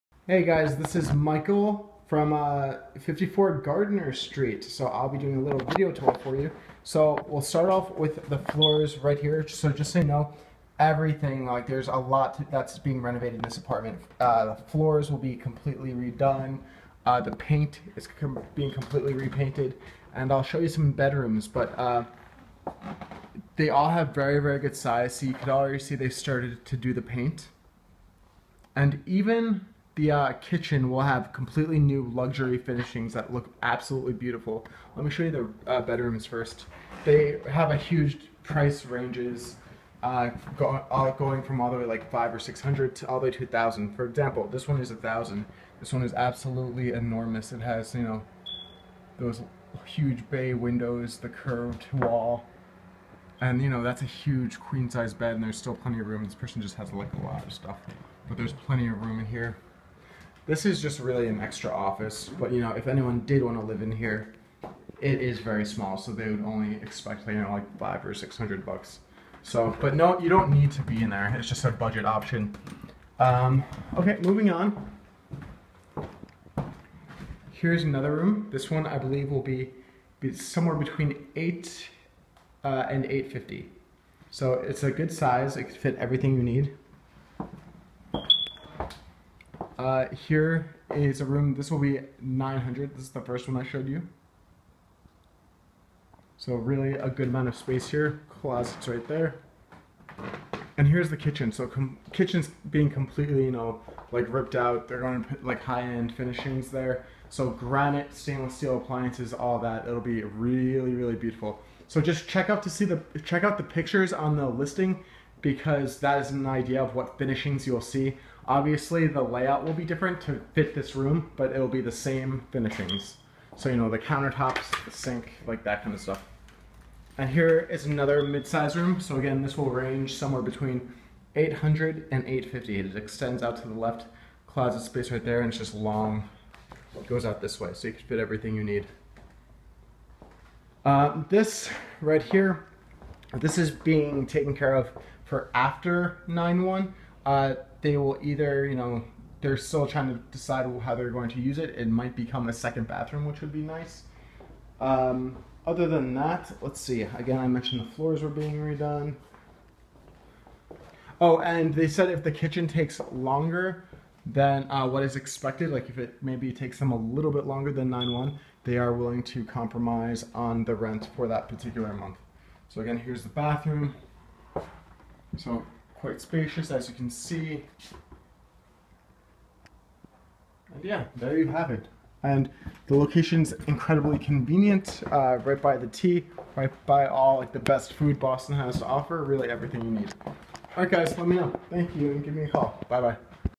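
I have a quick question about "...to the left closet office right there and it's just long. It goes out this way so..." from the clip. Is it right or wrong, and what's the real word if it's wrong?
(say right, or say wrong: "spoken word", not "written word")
wrong: "space", not "office".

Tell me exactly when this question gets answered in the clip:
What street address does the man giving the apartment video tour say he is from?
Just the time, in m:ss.
0:02.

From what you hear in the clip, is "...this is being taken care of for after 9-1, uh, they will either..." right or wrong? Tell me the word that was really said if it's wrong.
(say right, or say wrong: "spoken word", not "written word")
right.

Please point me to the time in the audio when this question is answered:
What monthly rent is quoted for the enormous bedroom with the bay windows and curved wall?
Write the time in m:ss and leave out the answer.
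0:44.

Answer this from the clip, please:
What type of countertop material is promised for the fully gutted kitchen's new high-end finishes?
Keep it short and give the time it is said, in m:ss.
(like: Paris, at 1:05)
Granite, at 1:47.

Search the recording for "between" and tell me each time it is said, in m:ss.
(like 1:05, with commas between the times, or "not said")
1:20, 2:10.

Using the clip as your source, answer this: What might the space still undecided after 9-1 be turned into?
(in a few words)
A second bathroom.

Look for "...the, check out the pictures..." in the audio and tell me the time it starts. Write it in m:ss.
1:52.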